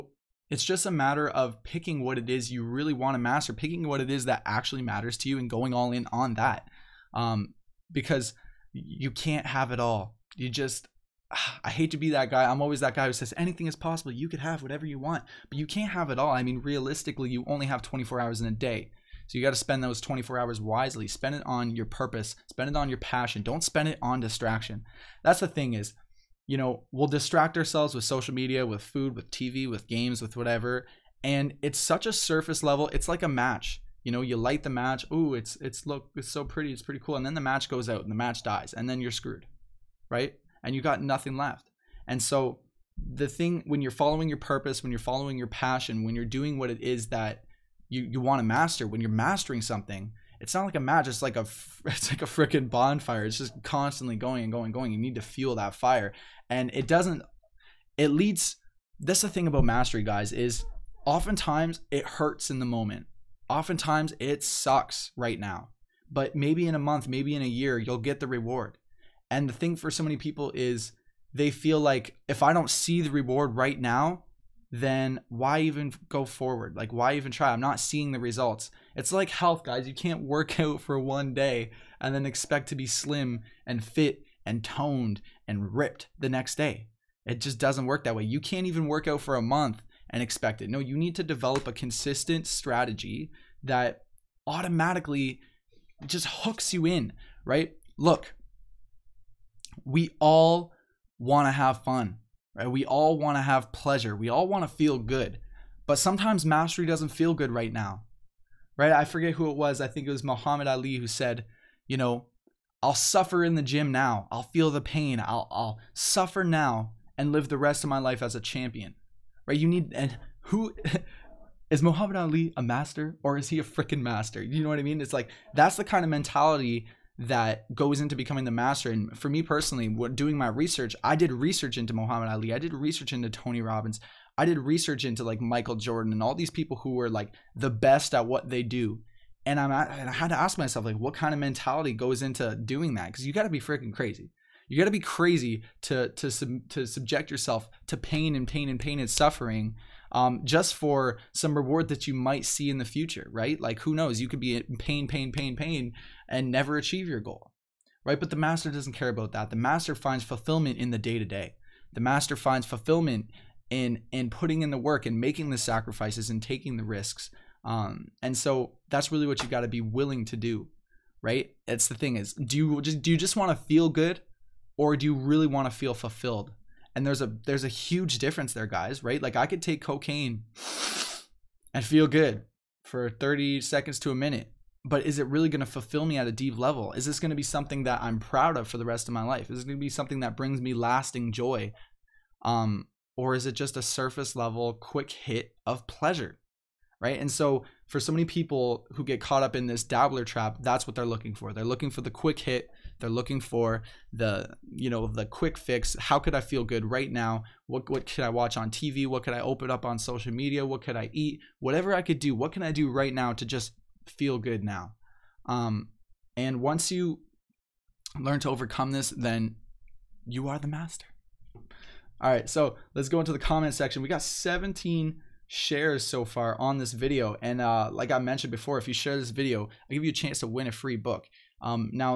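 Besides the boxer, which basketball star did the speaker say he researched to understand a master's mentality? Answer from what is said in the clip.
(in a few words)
Michael Jordan.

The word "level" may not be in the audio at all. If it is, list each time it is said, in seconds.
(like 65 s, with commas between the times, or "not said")
32 s, 186 s, 194 s.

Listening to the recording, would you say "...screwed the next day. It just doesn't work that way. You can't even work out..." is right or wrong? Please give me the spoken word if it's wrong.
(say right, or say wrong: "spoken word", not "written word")
wrong: "ripped", not "screwed".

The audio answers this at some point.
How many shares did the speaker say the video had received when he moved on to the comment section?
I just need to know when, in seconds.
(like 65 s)
224 s.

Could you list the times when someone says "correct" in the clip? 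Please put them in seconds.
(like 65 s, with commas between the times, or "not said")
not said.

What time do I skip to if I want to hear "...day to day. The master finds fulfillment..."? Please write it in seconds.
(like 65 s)
160 s.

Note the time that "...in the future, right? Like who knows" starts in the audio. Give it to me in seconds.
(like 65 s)
152 s.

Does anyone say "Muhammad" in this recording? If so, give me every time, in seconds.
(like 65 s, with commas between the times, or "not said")
110 s, 121 s, 131 s.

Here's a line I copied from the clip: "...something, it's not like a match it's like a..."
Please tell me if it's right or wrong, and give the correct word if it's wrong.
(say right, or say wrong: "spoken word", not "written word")
right.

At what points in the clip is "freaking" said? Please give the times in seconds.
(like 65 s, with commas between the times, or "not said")
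52 s, 123 s, 143 s.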